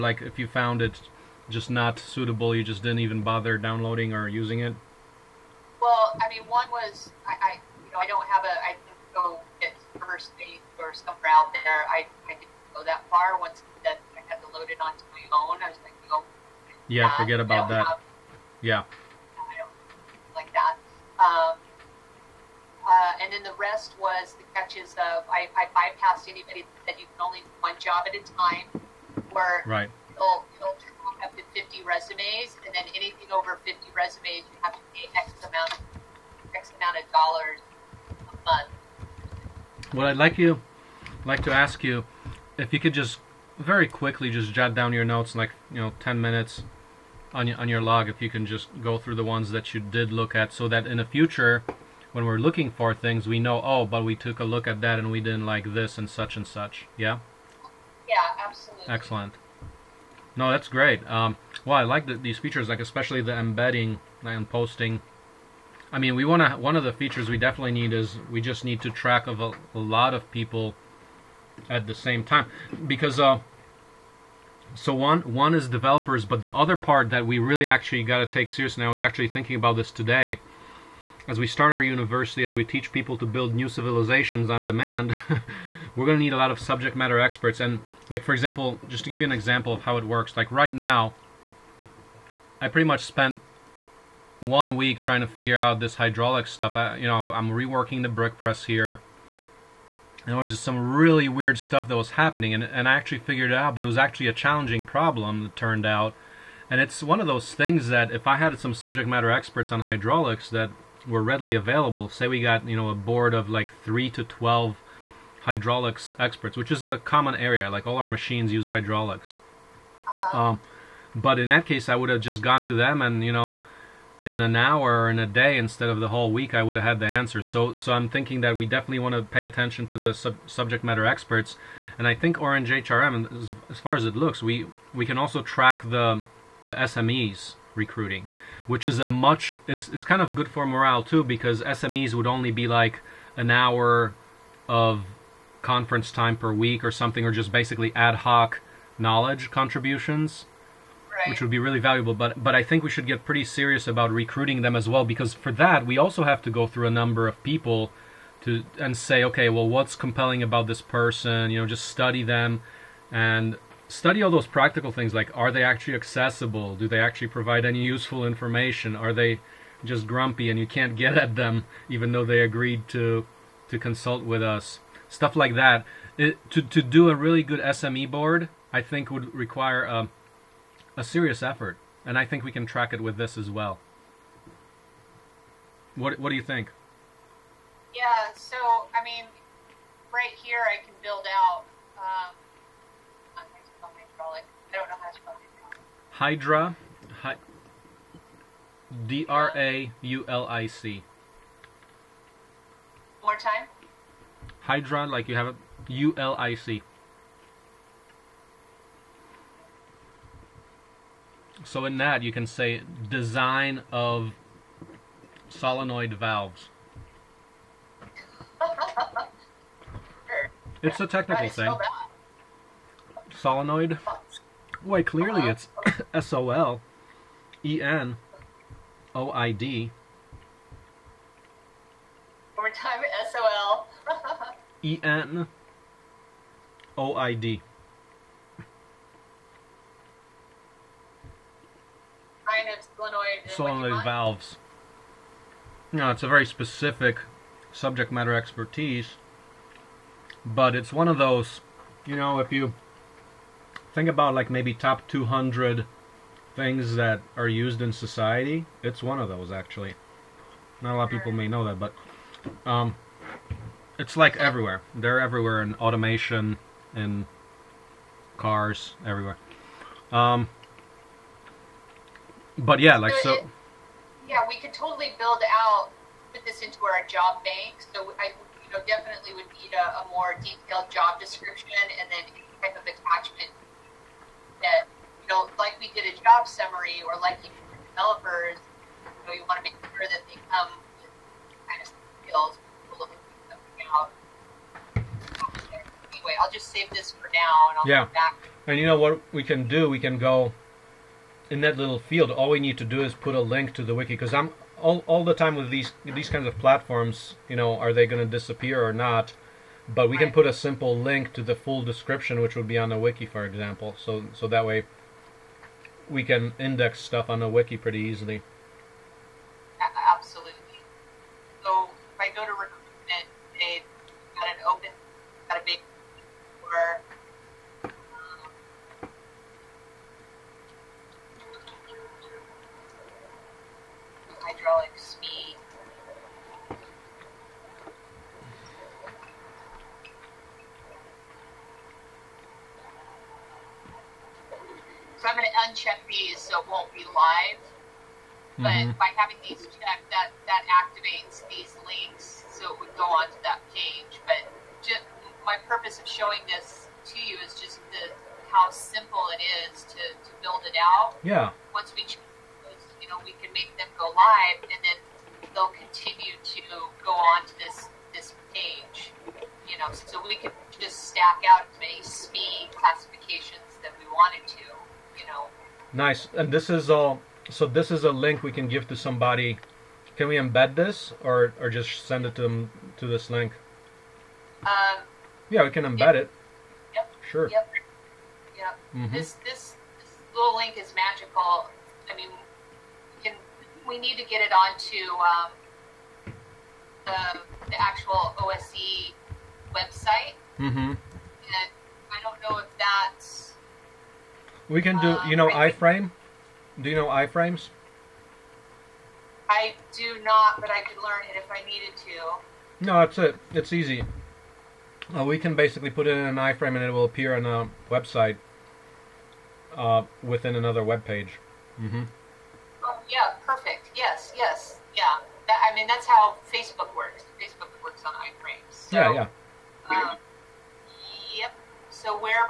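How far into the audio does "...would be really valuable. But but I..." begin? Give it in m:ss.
2:31.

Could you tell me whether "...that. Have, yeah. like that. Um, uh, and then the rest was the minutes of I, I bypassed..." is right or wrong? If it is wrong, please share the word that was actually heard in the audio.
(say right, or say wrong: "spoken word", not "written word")
wrong: "catches", not "minutes".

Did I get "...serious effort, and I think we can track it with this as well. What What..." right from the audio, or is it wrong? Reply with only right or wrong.
right.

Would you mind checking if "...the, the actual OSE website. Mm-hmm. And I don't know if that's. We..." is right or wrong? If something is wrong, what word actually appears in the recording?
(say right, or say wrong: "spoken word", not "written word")
right.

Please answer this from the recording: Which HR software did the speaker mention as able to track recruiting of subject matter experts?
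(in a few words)
Orange HRM.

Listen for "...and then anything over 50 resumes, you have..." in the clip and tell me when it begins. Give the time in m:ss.
0:32.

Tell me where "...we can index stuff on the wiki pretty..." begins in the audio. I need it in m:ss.
5:16.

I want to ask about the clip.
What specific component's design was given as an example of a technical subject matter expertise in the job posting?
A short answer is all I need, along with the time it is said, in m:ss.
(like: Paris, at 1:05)
Solenoid valves, at 3:35.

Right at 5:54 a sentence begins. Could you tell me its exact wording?
But just, my purpose of showing this to you is just the how simple it is to, to build it out.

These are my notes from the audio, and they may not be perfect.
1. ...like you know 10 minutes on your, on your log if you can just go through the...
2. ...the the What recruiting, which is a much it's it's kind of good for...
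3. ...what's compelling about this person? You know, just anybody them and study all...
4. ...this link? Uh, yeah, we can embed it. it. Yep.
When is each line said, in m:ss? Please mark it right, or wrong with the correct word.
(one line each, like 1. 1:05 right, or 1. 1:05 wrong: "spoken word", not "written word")
1. 0:45 right
2. 2:15 wrong: "SMEs", not "What"
3. 2:39 wrong: "study", not "anybody"
4. 6:23 right.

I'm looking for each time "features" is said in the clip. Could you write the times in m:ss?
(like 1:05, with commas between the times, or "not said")
1:02, 1:06.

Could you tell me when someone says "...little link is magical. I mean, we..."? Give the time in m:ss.
6:30.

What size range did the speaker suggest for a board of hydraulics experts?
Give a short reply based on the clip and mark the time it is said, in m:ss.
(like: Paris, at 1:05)
3 to 12, at 1:53.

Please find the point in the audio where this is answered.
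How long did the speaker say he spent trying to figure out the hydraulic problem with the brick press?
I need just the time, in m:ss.
1:34.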